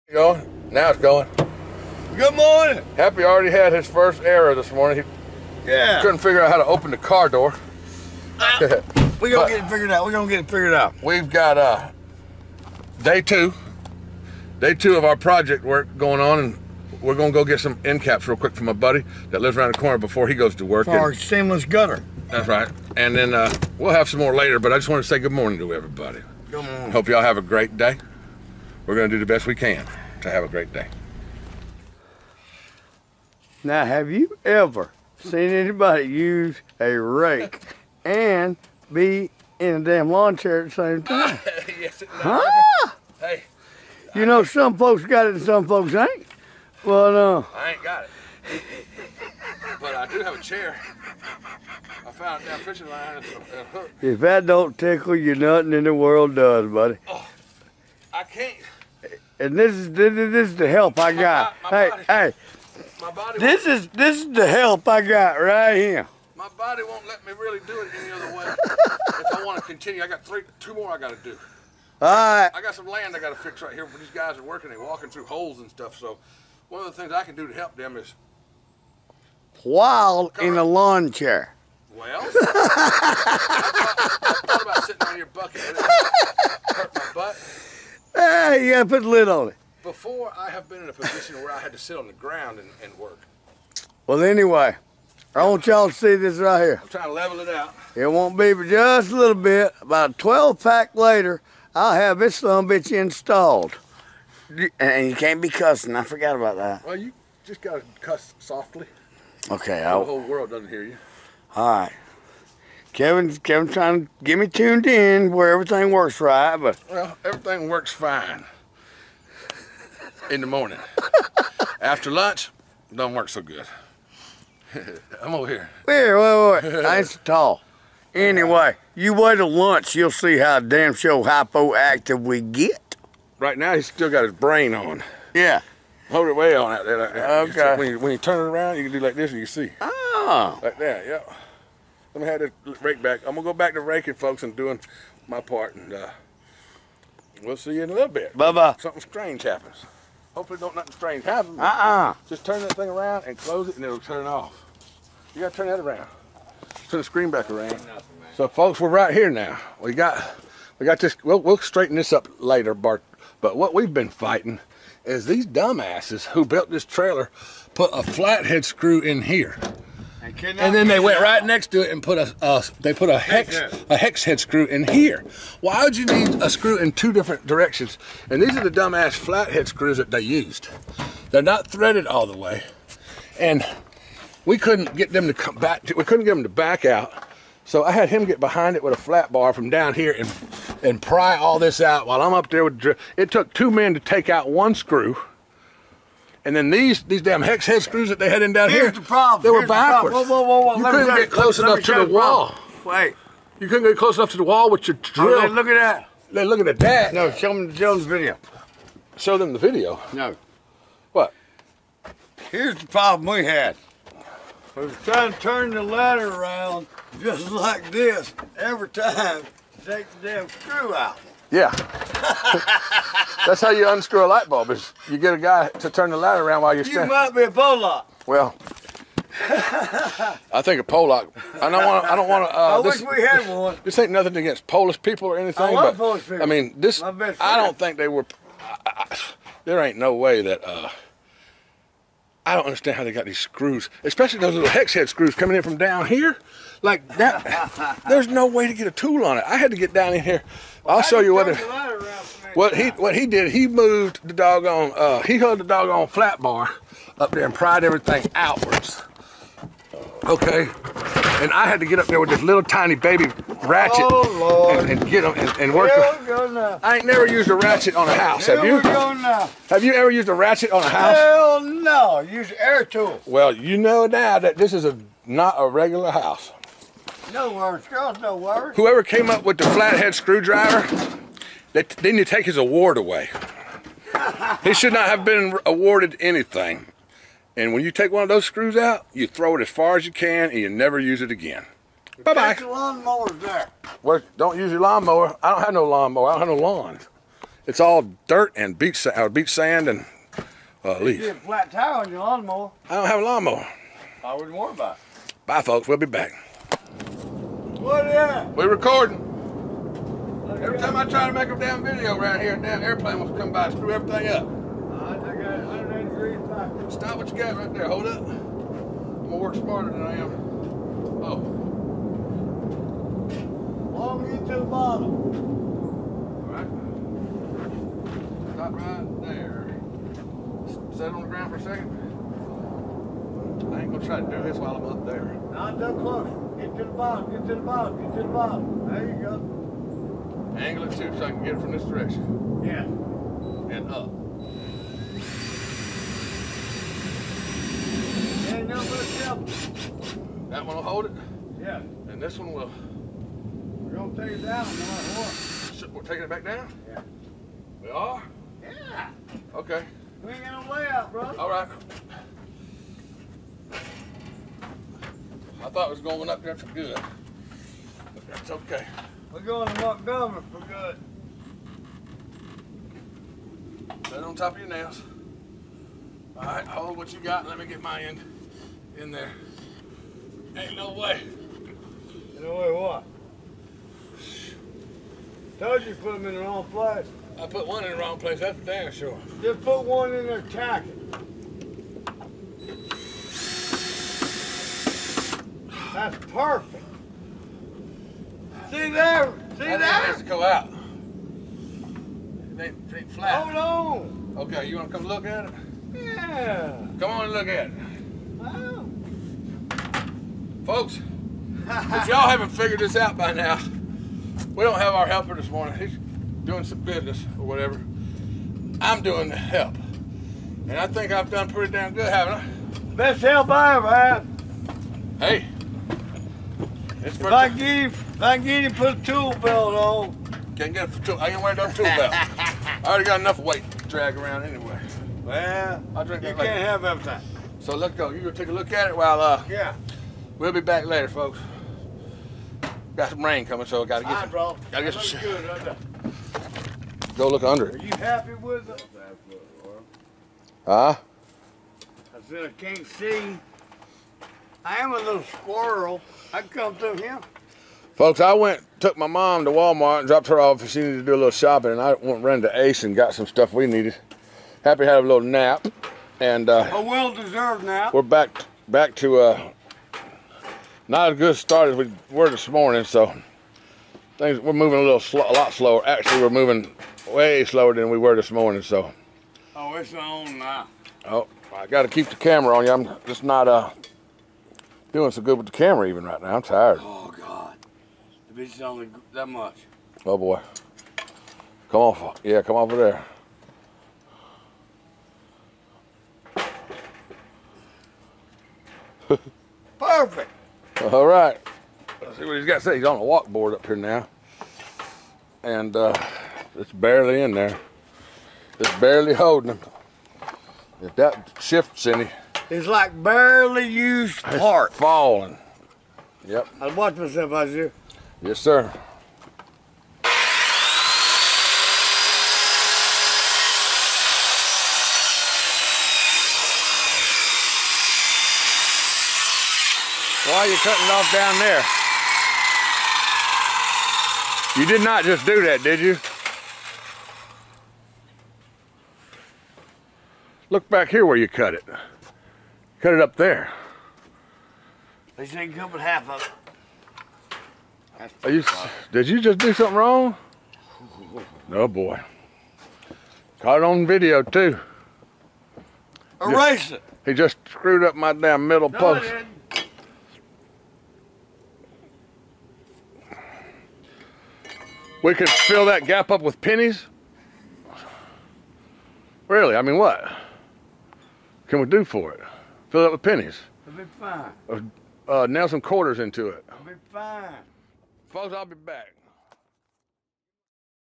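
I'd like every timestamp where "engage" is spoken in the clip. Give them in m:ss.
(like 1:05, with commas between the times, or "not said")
not said.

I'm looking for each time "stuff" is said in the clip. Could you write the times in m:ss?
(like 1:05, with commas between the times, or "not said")
1:15, 7:43.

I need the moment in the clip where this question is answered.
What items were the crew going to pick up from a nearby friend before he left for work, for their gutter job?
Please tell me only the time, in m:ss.
0:17.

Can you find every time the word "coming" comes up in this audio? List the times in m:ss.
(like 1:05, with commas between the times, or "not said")
4:05, 7:23.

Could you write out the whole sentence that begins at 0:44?
You I know, some folks got it and some folks ain't.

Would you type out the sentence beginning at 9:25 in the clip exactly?
We could fill that gap up with pennies.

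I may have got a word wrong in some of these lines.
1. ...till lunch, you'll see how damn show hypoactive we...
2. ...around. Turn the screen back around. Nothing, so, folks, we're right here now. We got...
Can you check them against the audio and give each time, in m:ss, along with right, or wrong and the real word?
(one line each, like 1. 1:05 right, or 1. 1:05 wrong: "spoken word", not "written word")
1. 2:09 right
2. 2:35 right.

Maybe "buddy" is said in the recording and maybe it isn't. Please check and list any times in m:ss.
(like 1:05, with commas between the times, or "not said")
0:18, 0:56.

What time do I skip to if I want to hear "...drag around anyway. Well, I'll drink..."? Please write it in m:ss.
7:13.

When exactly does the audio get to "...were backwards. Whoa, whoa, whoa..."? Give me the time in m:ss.
3:19.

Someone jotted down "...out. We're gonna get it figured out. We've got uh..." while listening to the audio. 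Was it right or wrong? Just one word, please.
right.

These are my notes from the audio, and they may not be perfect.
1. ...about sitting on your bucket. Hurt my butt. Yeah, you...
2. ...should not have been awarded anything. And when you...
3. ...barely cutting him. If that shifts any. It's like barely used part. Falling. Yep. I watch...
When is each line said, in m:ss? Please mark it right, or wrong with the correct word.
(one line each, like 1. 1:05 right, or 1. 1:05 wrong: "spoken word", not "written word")
1. 1:24 right
2. 4:44 right
3. 8:28 wrong: "holding", not "cutting".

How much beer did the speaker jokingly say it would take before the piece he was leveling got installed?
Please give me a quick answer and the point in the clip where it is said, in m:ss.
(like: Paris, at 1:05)
A 12 pack, at 1:40.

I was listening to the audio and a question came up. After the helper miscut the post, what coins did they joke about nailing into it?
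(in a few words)
Quarters.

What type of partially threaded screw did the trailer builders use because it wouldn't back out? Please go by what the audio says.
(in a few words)
Flathead screws.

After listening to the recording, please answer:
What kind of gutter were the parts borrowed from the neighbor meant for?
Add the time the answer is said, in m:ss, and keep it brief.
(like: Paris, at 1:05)
Seamless gutter, at 0:21.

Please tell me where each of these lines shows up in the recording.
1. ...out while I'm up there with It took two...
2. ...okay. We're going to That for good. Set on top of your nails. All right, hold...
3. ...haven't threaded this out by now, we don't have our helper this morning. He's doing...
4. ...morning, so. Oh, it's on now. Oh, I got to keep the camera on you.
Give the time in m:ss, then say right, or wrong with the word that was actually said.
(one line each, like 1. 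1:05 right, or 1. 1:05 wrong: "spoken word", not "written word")
1. 3:11 right
2. 6:08 wrong: "Montgomery", not "That"
3. 6:52 wrong: "figured", not "threaded"
4. 7:58 right.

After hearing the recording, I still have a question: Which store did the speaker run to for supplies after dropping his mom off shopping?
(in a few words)
Ace.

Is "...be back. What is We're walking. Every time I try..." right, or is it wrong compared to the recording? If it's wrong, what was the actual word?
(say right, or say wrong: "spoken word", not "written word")
wrong: "recording", not "walking".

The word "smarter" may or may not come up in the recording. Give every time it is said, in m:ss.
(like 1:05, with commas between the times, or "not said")
5:19.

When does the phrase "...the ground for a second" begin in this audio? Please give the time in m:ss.
5:31.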